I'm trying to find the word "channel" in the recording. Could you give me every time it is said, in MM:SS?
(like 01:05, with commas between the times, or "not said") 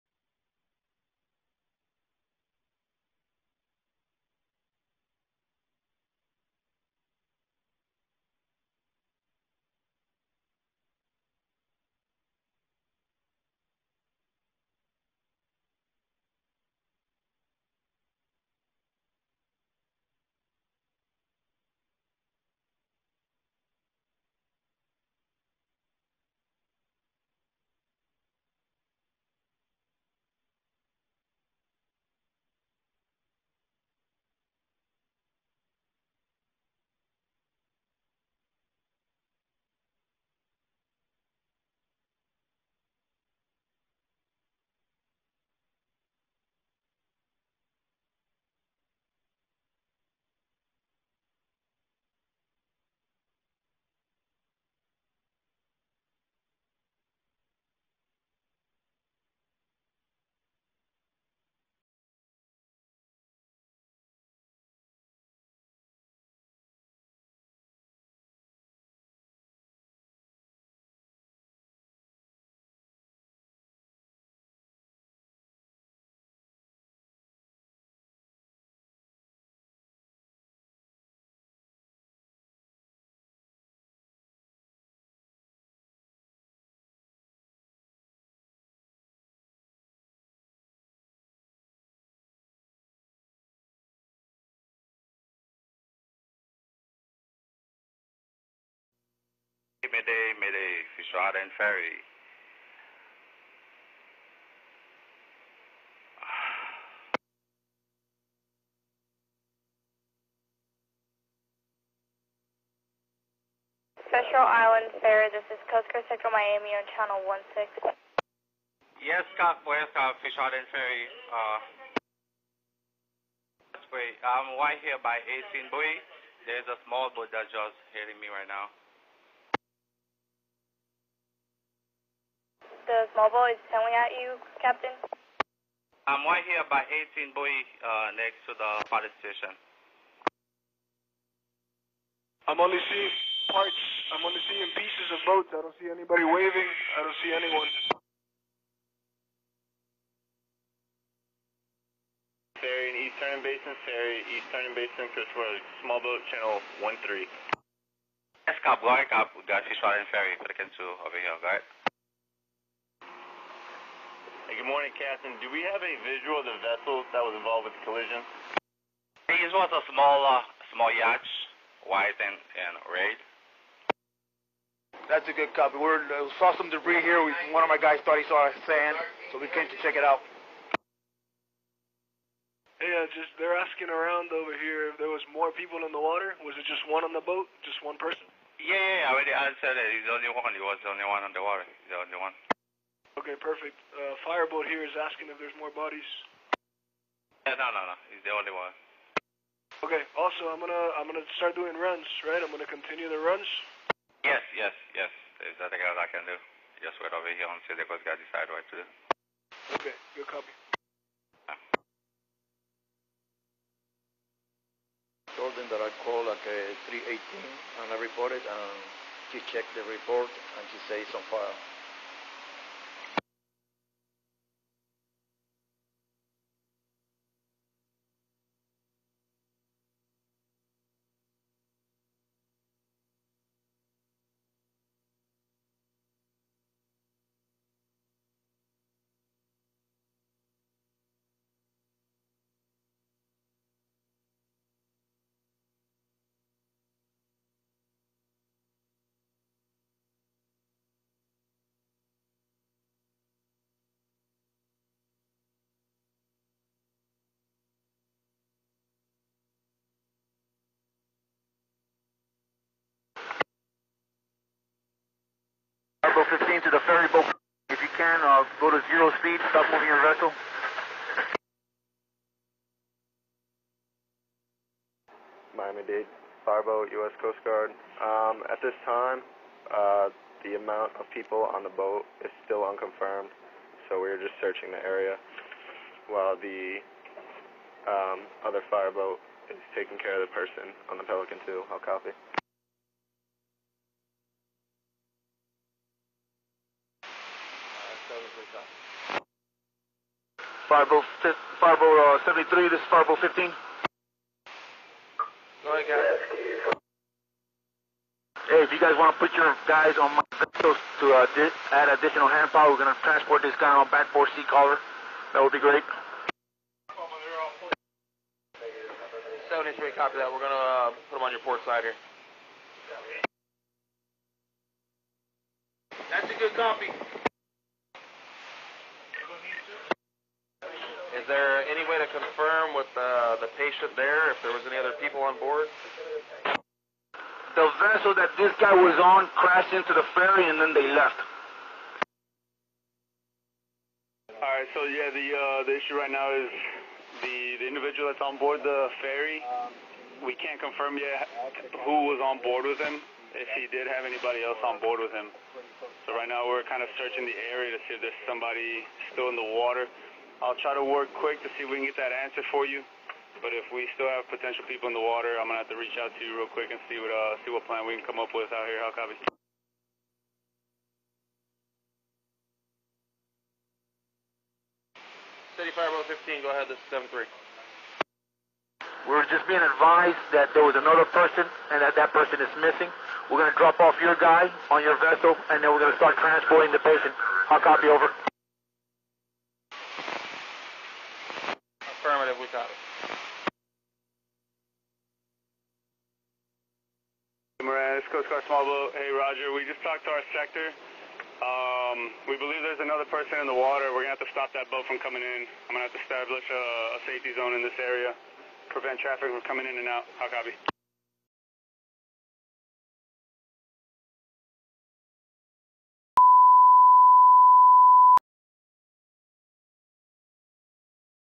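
01:56, 02:36.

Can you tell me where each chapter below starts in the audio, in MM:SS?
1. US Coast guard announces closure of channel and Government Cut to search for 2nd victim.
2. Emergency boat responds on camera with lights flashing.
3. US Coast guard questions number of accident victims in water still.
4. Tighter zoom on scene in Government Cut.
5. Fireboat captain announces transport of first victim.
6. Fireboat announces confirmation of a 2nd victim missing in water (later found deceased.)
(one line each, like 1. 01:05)
1. 06:35
2. 02:59
3. 04:35
4. 03:35
5. 05:08
6. 06:17.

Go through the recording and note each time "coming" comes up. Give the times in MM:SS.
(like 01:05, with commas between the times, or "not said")
06:45, 06:49.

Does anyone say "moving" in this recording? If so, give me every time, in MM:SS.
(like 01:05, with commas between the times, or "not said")
04:29.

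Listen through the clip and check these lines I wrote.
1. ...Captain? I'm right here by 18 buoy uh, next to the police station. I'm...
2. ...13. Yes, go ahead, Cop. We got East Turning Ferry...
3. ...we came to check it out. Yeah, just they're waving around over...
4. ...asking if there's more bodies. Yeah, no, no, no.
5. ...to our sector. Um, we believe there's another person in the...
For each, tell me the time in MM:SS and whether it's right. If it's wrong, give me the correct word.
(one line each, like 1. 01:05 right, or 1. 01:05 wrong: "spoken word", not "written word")
1. 02:14 right
2. 02:36 right
3. 02:59 wrong: "asking", not "waving"
4. 03:14 right
5. 06:40 right.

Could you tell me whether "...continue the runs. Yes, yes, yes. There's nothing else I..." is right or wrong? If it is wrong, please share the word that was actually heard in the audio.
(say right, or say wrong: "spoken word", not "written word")
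right.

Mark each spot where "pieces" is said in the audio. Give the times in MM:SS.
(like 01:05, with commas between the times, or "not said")
02:24.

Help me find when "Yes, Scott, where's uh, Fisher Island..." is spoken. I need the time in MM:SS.
01:59.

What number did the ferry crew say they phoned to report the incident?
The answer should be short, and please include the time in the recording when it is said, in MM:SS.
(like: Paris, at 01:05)
318, at 03:36.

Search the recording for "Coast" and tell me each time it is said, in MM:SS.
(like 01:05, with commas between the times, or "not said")
01:55, 04:37, 06:38.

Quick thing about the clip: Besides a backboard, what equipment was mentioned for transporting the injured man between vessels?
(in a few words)
Sea collar.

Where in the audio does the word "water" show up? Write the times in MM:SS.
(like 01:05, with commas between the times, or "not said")
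03:06, 03:11, 05:59, 06:05, 06:43.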